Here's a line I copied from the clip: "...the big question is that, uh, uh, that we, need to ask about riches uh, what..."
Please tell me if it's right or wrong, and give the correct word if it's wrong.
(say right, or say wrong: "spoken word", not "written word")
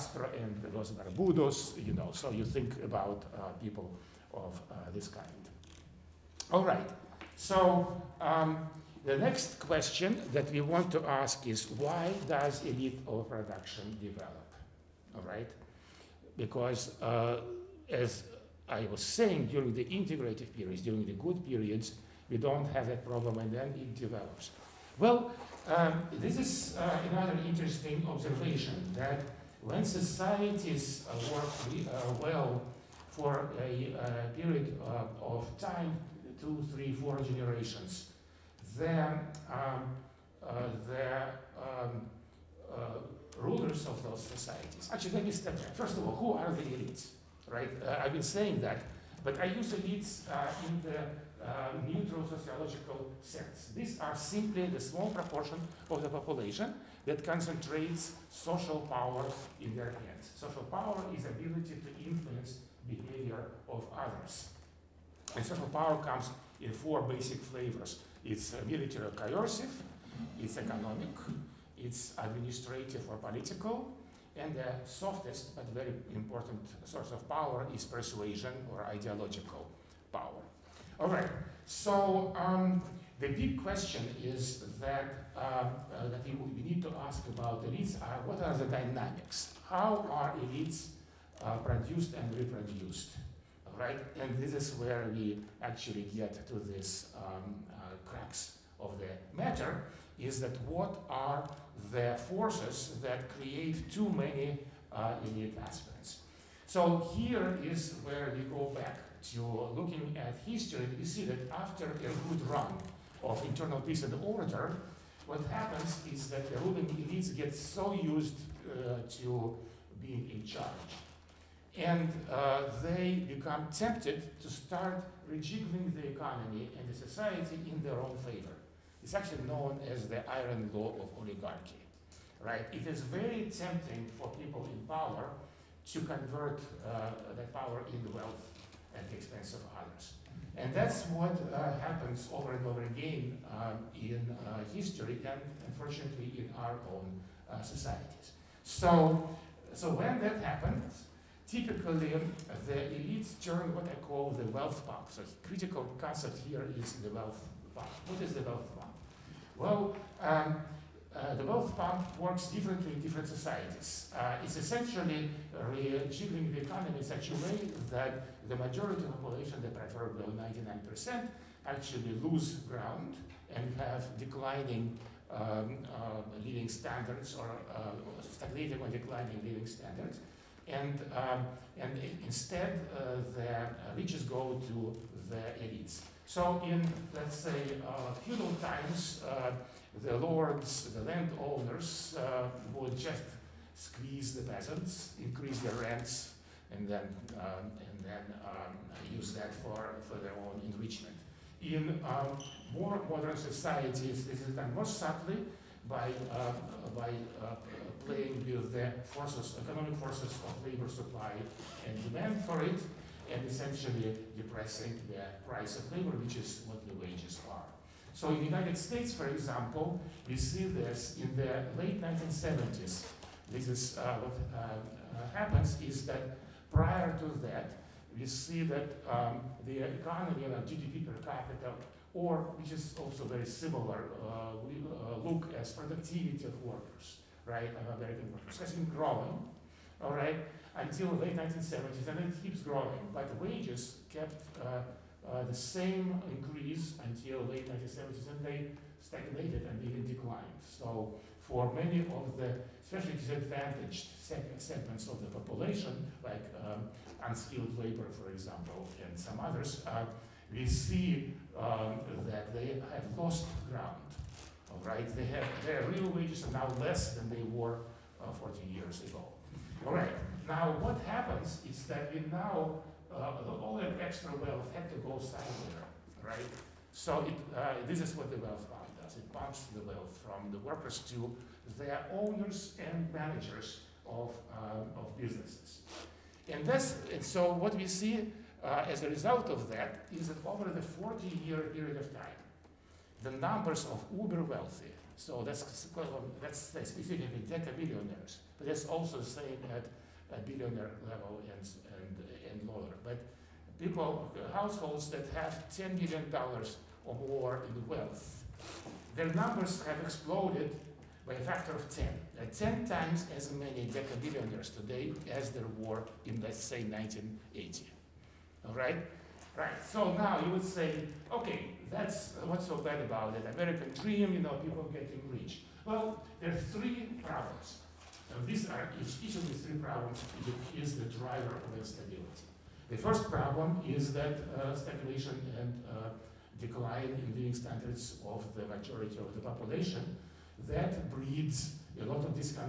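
wrong: "elites", not "riches".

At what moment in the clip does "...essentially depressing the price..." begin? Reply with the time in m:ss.
3:33.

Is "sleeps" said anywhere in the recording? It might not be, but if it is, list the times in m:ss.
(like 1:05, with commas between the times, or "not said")
not said.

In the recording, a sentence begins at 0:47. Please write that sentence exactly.
Uh, I've been saying that, but I use elites in the uh, neutral sociological sects.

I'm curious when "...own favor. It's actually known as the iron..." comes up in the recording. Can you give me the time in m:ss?
2:07.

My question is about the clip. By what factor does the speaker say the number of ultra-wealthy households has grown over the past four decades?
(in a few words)
10.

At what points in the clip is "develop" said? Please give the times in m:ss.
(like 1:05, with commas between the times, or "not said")
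0:14, 0:23.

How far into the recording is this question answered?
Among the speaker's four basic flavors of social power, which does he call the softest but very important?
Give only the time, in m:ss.
1:17.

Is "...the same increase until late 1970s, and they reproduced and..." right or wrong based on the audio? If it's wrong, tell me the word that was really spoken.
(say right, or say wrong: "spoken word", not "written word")
wrong: "stagnated", not "reproduced".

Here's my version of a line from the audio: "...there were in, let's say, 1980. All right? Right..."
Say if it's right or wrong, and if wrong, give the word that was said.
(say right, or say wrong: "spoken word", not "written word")
right.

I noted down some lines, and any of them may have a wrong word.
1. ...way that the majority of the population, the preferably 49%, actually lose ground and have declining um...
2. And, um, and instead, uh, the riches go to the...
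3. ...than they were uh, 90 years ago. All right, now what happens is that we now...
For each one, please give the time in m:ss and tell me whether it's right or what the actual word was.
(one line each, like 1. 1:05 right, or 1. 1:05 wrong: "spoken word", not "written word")
1. 2:47 wrong: "99", not "49"
2. 3:00 right
3. 4:27 wrong: "40", not "90".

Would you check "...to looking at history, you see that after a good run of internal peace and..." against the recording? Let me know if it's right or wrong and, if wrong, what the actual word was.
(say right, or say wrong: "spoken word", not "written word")
right.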